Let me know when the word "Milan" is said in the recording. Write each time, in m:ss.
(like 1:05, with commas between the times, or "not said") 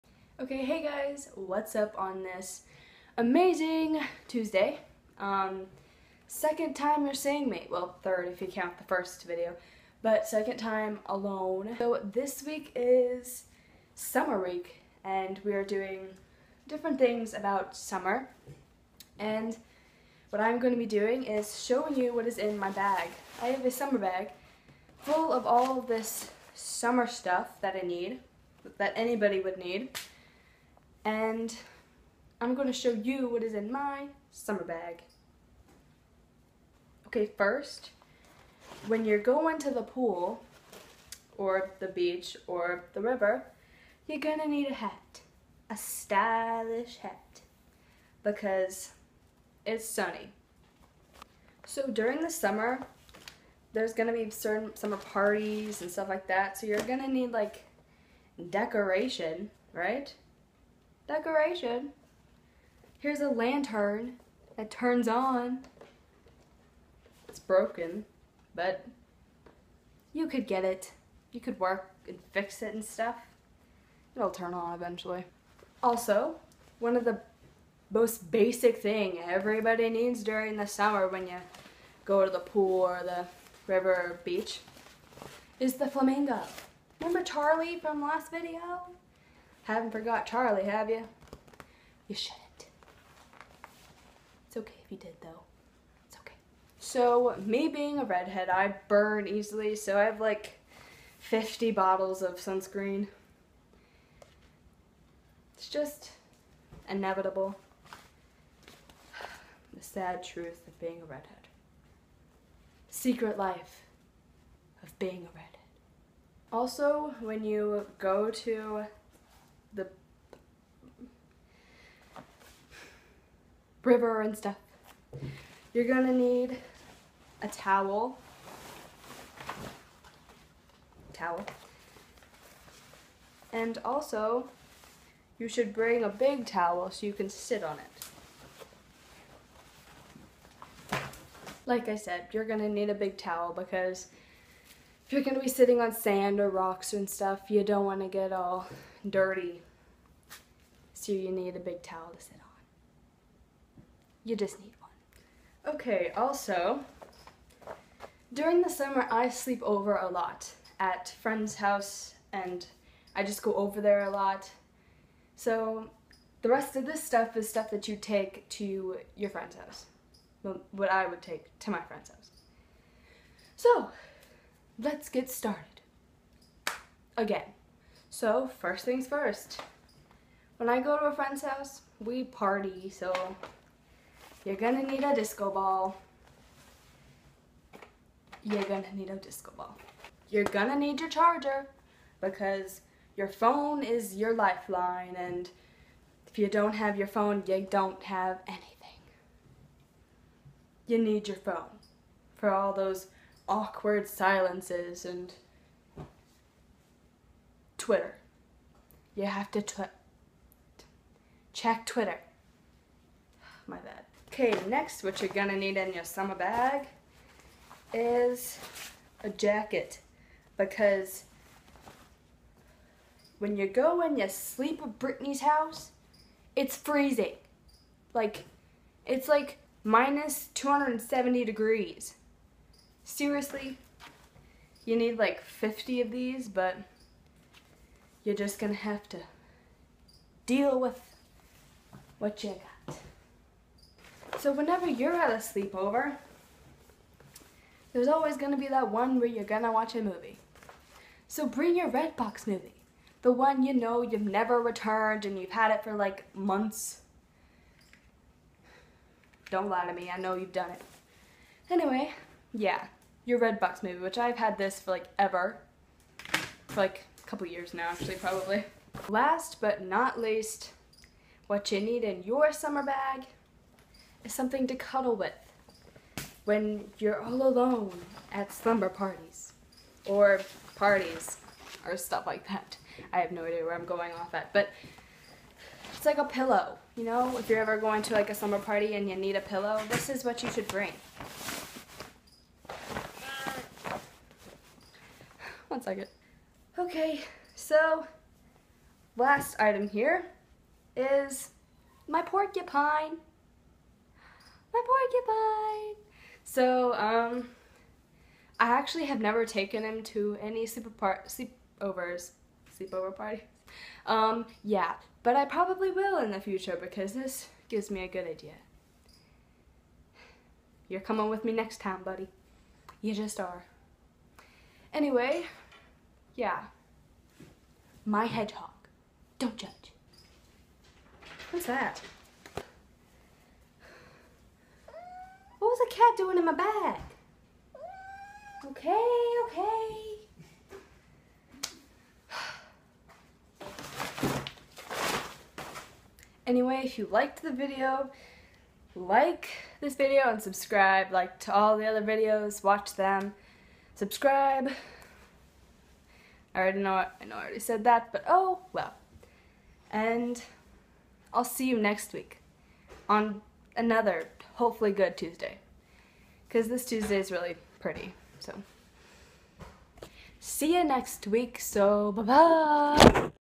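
not said.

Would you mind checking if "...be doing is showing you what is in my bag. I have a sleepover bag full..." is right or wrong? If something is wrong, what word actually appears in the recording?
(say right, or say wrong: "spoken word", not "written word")
wrong: "summer", not "sleepover".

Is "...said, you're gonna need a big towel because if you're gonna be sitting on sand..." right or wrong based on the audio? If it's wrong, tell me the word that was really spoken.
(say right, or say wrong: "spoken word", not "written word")
right.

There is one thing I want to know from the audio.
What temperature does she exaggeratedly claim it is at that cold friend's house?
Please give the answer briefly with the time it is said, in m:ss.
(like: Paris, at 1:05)
minus 270 degrees, at 3:49.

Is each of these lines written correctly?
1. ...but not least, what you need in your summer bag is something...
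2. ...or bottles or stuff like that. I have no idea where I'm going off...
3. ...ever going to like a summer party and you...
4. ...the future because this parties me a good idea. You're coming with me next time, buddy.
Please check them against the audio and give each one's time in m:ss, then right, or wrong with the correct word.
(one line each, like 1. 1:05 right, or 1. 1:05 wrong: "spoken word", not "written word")
1. 4:29 right
2. 4:40 wrong: "parties", not "bottles"
3. 4:47 right
4. 5:16 wrong: "gives", not "parties".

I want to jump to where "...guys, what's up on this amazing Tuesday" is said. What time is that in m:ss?
0:00.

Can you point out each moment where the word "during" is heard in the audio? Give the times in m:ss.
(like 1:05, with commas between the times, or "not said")
0:51, 1:20, 2:38.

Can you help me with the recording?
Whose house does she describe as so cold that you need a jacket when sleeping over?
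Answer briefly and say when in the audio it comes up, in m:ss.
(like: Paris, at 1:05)
Brittany, at 3:44.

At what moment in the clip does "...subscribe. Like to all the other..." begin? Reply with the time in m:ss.
5:50.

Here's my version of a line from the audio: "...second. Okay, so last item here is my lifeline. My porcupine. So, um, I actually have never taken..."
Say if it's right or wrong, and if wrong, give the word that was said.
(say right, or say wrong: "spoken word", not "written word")
wrong: "porcupine", not "lifeline".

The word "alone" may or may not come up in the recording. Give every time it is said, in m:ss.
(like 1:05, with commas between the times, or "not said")
0:11, 4:37.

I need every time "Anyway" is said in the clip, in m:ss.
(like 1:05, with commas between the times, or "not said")
4:21, 5:24, 5:46.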